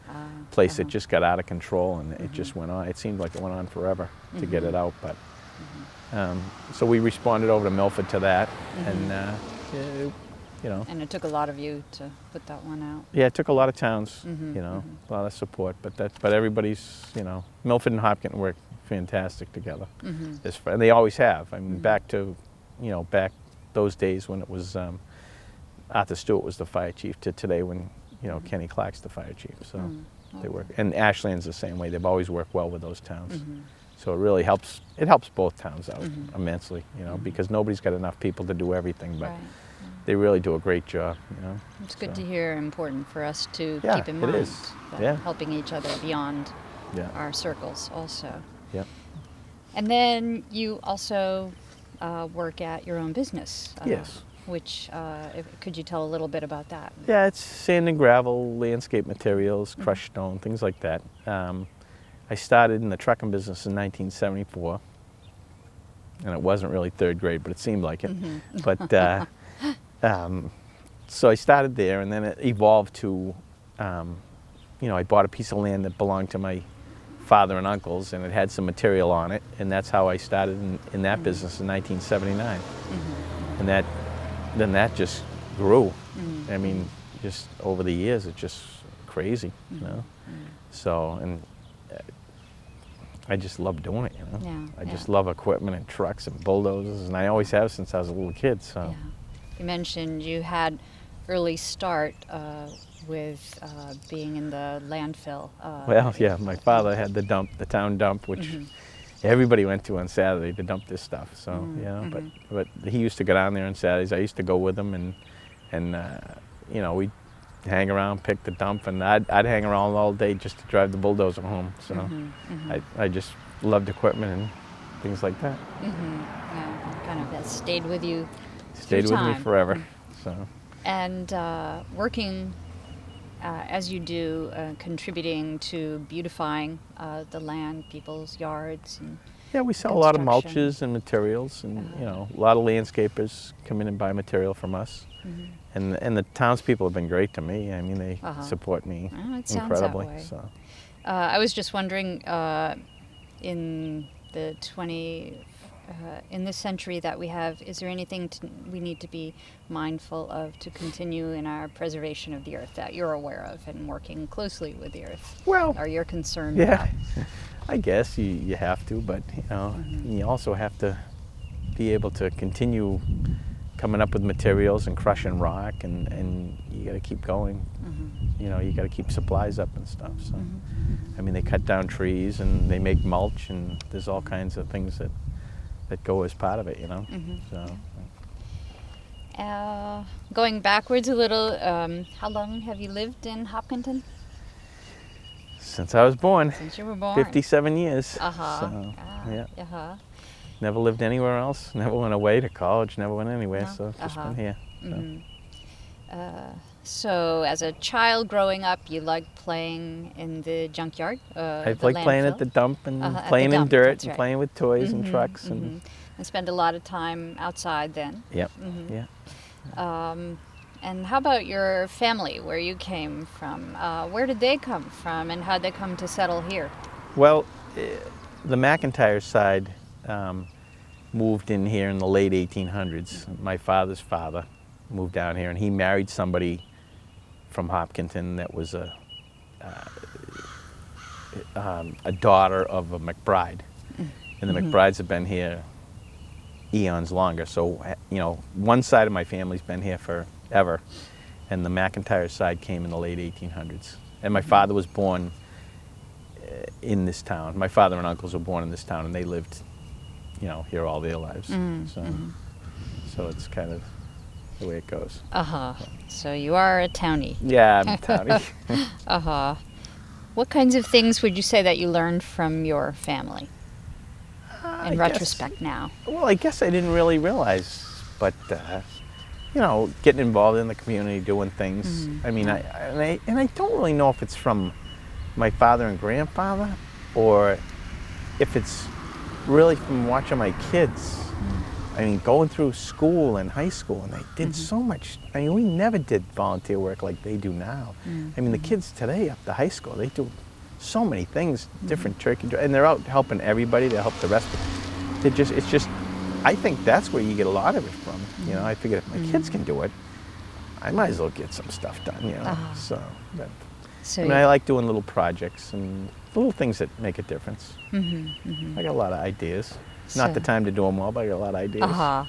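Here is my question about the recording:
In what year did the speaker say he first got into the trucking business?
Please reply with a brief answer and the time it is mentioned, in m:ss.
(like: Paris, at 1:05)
1974, at 1:03.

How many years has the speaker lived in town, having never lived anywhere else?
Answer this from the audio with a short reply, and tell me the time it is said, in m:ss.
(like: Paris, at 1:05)
57, at 3:17.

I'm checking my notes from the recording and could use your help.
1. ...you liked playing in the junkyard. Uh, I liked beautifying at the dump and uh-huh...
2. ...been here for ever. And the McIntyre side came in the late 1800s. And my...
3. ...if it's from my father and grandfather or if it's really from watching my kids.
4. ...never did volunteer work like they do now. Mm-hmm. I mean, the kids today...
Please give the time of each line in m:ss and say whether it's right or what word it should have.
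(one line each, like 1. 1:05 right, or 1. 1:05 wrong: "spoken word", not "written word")
1. 3:28 wrong: "playing", not "beautifying"
2. 4:09 right
3. 4:44 right
4. 4:55 right.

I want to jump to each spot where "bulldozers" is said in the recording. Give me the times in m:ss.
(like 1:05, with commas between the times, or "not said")
1:36, 2:00.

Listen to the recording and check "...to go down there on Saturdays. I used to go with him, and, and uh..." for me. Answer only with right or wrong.
right.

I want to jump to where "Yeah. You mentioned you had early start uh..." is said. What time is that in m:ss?
1:38.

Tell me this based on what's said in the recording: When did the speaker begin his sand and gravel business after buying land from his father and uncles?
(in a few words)
1979.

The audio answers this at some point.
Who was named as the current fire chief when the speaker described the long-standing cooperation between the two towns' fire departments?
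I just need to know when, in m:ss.
0:28.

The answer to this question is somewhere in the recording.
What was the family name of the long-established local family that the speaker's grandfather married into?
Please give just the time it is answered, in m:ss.
4:02.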